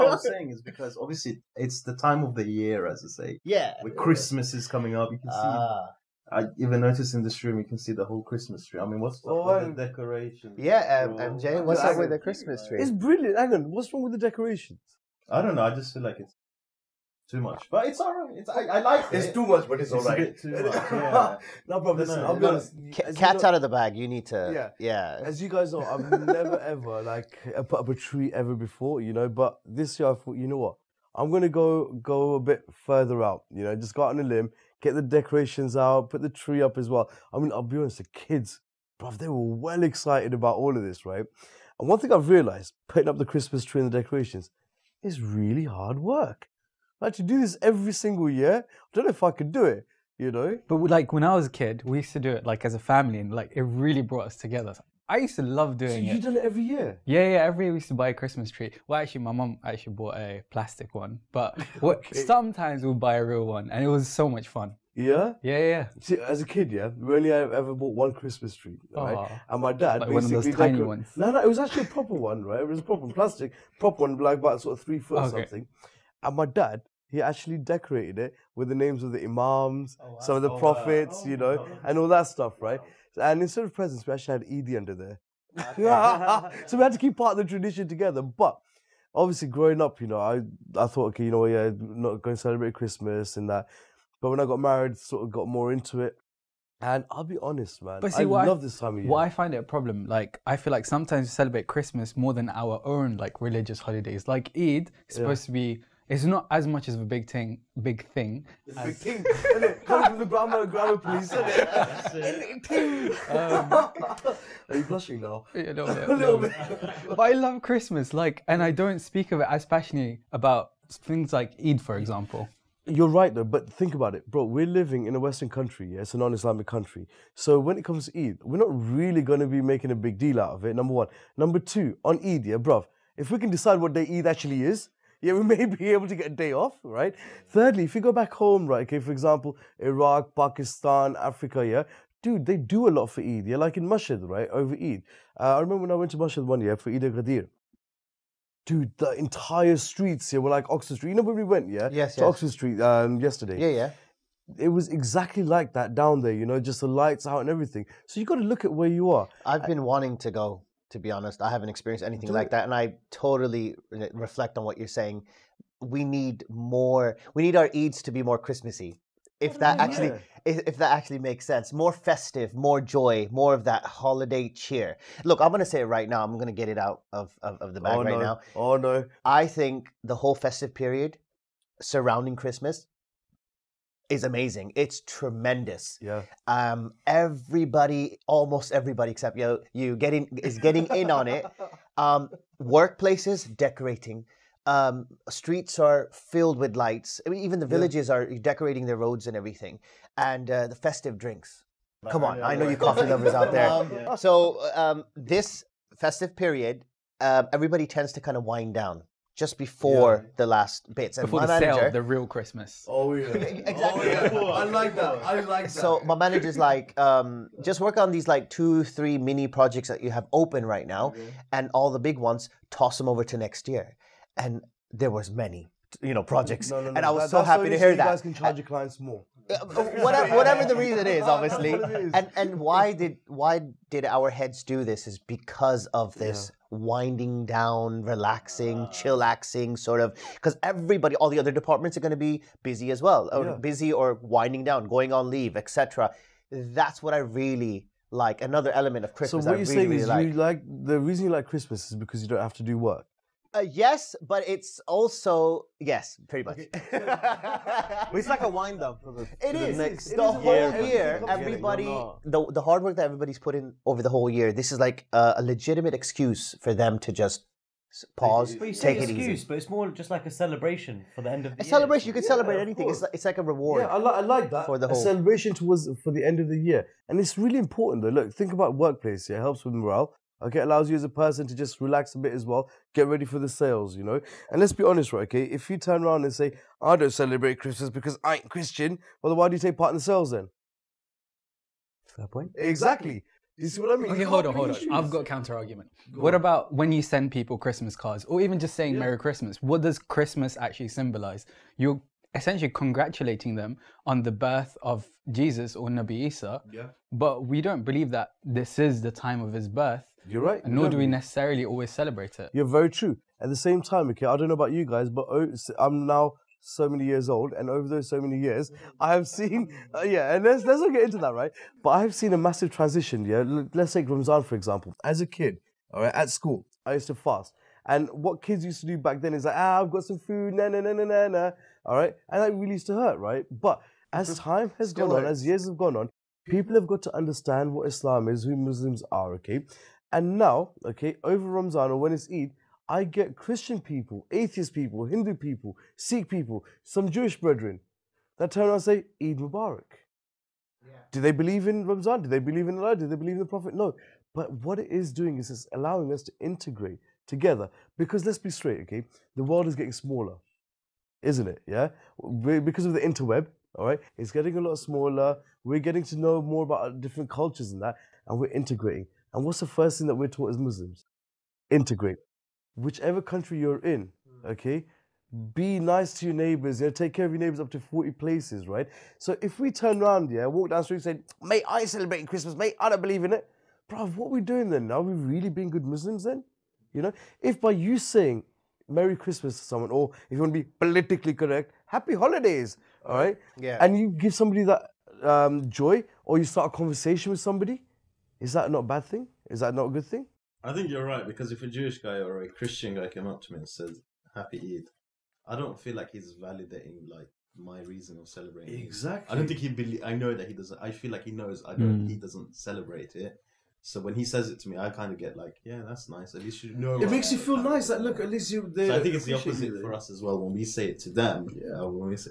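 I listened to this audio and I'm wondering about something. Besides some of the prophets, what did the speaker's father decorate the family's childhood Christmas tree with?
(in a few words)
Names of the imams.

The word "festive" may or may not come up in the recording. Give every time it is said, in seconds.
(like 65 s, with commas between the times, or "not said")
171 s, 180 s, 200 s, 205 s.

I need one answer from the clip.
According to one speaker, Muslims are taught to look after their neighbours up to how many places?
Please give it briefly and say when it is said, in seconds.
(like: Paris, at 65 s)
40, at 377 s.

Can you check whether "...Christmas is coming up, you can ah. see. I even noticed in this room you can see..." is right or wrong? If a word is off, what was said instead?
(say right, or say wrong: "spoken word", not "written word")
right.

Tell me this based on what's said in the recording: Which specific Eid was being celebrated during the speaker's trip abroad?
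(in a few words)
Eid al-Ghadir.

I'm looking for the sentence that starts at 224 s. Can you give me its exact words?
And there was many, you know, projects, no, no, no.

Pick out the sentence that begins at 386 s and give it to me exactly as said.
You know, if by you saying Merry Christmas to someone, or if you want to be politically correct, Happy Holidays, all right?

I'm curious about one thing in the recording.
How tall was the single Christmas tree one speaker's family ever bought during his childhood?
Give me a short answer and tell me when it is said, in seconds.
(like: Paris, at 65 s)
3 feet, at 74 s.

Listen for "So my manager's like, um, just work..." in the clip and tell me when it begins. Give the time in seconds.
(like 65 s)
215 s.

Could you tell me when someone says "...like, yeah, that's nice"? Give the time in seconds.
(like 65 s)
415 s.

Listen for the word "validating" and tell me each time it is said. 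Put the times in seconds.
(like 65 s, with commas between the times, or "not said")
406 s.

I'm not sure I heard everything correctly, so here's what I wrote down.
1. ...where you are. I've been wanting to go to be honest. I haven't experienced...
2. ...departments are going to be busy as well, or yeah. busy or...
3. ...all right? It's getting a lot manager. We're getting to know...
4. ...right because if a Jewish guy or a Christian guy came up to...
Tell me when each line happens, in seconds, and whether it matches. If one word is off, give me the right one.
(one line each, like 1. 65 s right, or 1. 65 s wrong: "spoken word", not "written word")
1. 158 s right
2. 241 s right
3. 363 s wrong: "smaller", not "manager"
4. 401 s right.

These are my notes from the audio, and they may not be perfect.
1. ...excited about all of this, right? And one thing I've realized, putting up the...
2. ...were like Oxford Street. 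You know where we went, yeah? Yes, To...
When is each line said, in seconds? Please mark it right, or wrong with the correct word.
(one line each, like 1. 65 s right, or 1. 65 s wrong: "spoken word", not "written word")
1. 39 s right
2. 150 s right.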